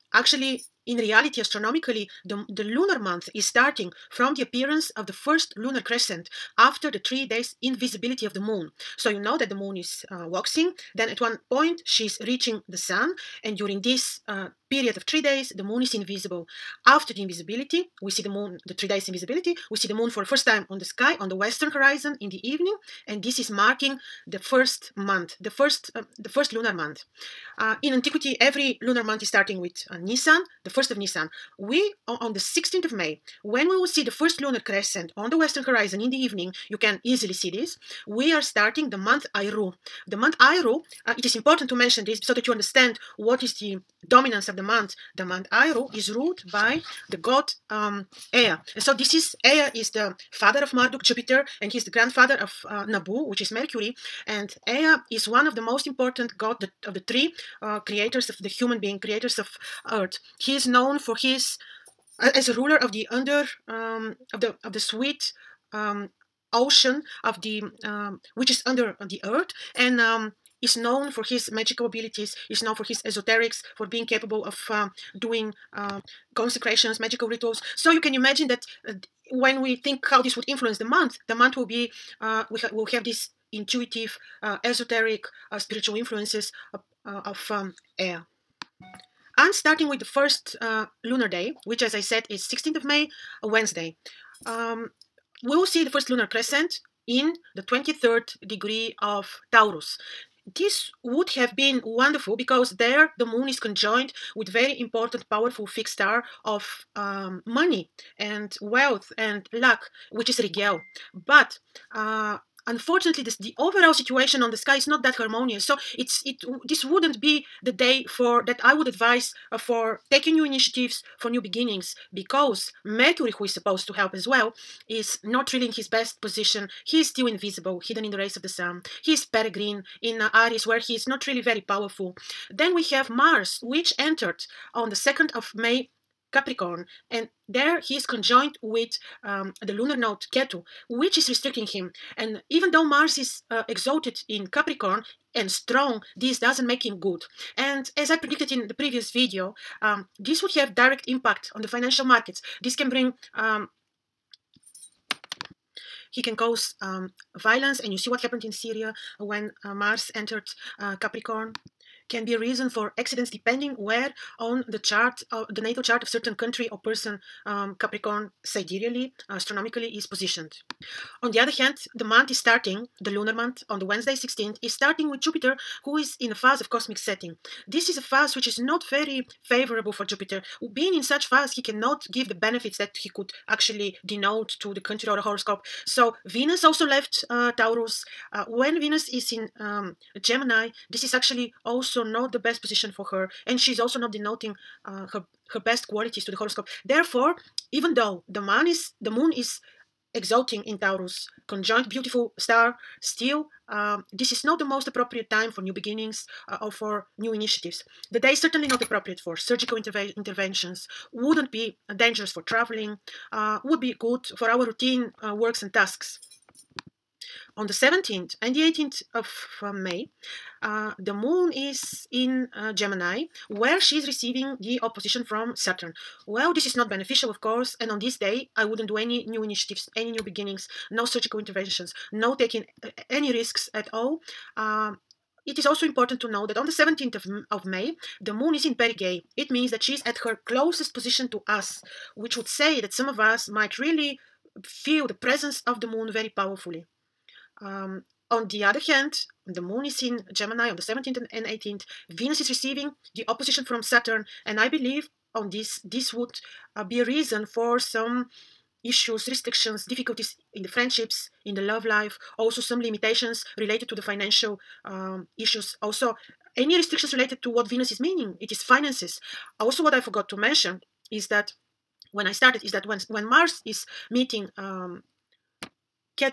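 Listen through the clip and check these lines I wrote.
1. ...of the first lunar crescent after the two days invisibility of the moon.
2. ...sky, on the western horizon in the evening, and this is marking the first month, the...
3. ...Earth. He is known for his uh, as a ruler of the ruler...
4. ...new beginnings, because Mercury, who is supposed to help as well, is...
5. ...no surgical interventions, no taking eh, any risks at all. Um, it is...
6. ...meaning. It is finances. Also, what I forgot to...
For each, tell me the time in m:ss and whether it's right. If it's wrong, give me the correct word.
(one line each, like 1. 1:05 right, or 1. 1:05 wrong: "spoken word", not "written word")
1. 0:04 wrong: "three", not "two"
2. 0:20 right
3. 0:59 wrong: "under", not "ruler"
4. 2:01 right
5. 3:50 right
6. 4:27 right.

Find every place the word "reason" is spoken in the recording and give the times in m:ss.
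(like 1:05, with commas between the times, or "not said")
2:42, 4:17.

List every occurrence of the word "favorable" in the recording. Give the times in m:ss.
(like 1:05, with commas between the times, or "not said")
2:59.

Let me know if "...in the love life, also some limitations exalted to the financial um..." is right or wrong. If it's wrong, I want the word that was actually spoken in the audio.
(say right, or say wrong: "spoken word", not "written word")
wrong: "related", not "exalted".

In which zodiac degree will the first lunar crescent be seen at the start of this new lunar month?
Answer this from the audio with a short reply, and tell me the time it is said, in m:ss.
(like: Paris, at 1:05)
23rd degree of Taurus, at 1:37.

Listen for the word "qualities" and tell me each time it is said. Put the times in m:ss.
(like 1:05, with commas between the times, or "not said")
3:15.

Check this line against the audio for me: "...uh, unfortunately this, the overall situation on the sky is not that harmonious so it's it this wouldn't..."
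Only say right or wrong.
right.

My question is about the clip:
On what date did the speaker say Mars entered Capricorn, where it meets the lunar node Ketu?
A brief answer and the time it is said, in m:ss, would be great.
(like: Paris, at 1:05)
May 2, at 2:14.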